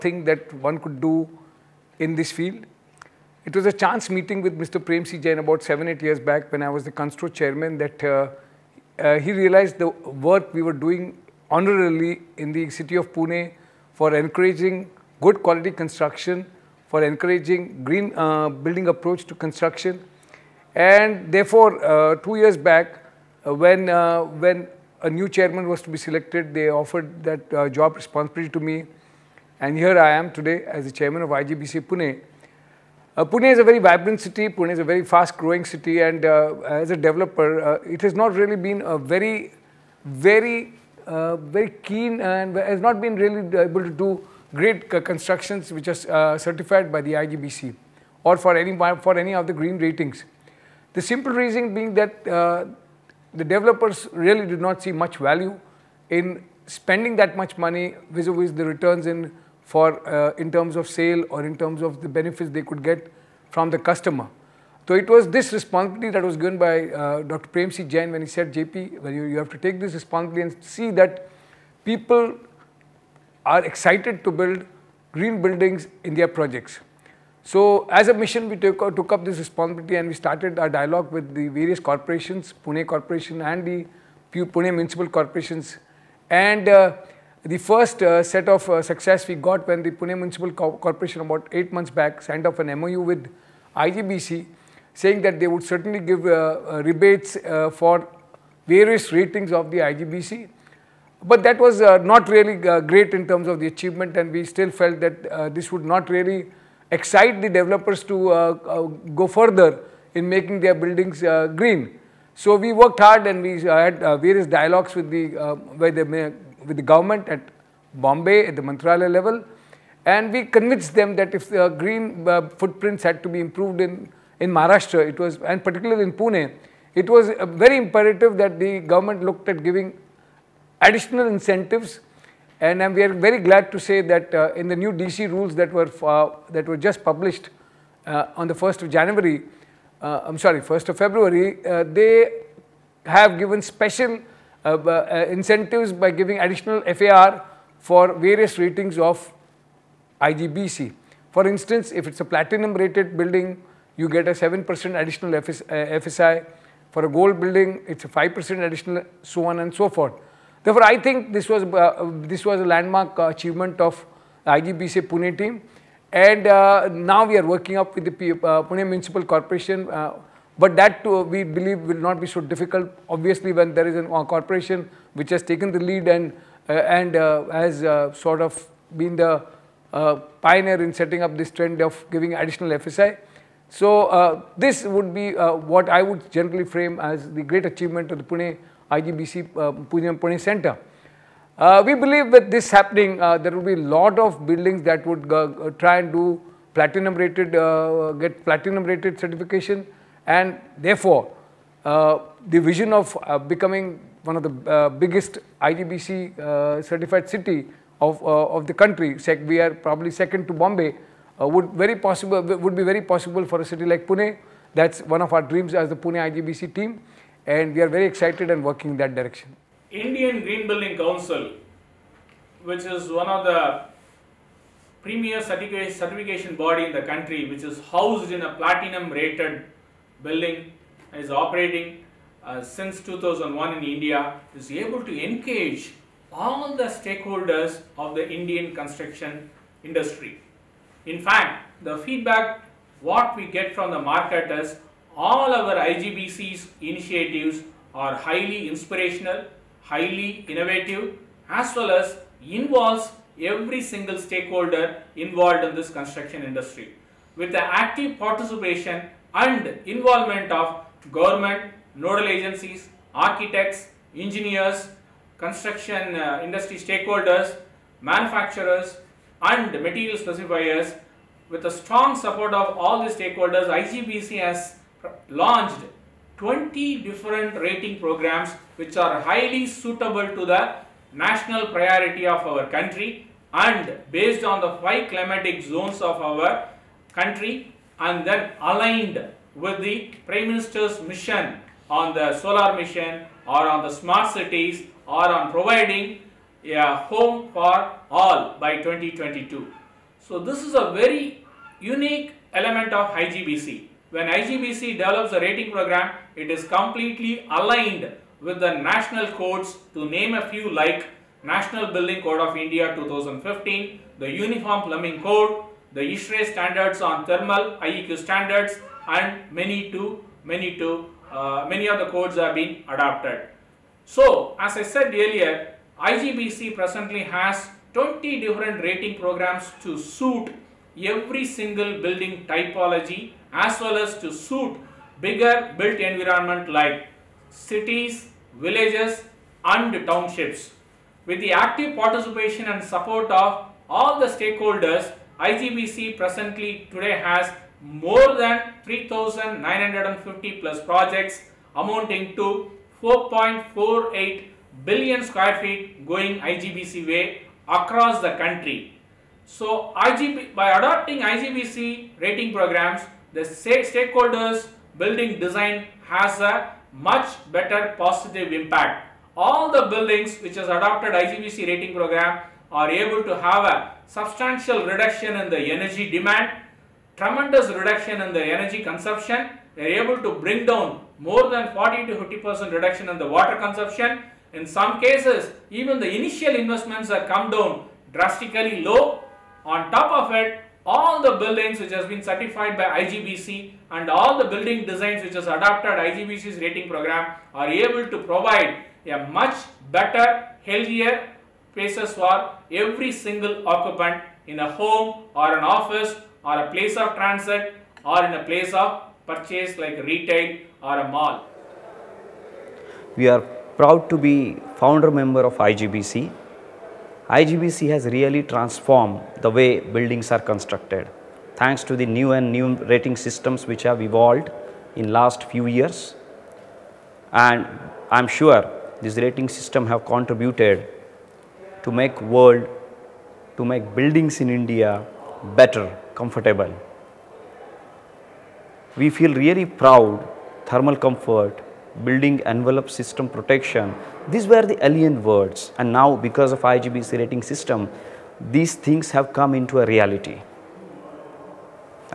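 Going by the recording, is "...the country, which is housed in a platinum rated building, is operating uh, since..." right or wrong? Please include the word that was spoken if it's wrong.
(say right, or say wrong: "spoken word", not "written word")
right.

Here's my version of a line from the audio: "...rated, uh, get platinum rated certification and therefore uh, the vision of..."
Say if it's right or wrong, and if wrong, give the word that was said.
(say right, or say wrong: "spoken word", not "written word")
right.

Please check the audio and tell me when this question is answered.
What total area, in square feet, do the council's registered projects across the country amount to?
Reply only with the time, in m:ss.
5:53.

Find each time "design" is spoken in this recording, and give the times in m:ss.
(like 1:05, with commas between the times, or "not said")
6:05, 6:34.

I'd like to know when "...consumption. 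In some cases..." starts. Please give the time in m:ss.
6:23.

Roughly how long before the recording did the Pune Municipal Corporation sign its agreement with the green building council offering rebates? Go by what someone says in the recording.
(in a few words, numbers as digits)
8 months.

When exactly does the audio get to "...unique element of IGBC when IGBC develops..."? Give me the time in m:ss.
5:01.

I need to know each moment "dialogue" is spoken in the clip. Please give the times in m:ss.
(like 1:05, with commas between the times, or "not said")
1:20, 1:54.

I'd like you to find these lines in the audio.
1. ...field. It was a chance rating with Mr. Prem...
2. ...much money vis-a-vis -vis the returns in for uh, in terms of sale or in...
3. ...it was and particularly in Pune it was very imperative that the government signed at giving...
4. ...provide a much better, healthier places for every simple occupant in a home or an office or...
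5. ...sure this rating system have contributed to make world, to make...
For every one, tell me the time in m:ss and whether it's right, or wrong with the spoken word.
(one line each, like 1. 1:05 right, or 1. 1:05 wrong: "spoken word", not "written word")
1. 0:02 wrong: "meeting", not "rating"
2. 0:57 right
3. 2:05 wrong: "looked", not "signed"
4. 6:38 wrong: "single", not "simple"
5. 7:08 right.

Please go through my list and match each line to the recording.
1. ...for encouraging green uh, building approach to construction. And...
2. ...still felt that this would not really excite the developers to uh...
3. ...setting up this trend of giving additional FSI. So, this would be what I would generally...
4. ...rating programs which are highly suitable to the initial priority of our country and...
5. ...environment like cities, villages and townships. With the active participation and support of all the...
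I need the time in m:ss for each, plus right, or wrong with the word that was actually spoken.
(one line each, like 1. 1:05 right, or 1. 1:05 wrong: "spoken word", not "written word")
1. 0:16 right
2. 1:44 right
3. 3:00 right
4. 4:37 wrong: "national", not "initial"
5. 5:36 right.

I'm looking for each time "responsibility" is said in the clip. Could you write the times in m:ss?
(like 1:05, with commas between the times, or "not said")
0:27, 1:05, 1:09, 1:19.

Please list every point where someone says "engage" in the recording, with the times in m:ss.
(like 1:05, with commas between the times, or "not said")
3:55.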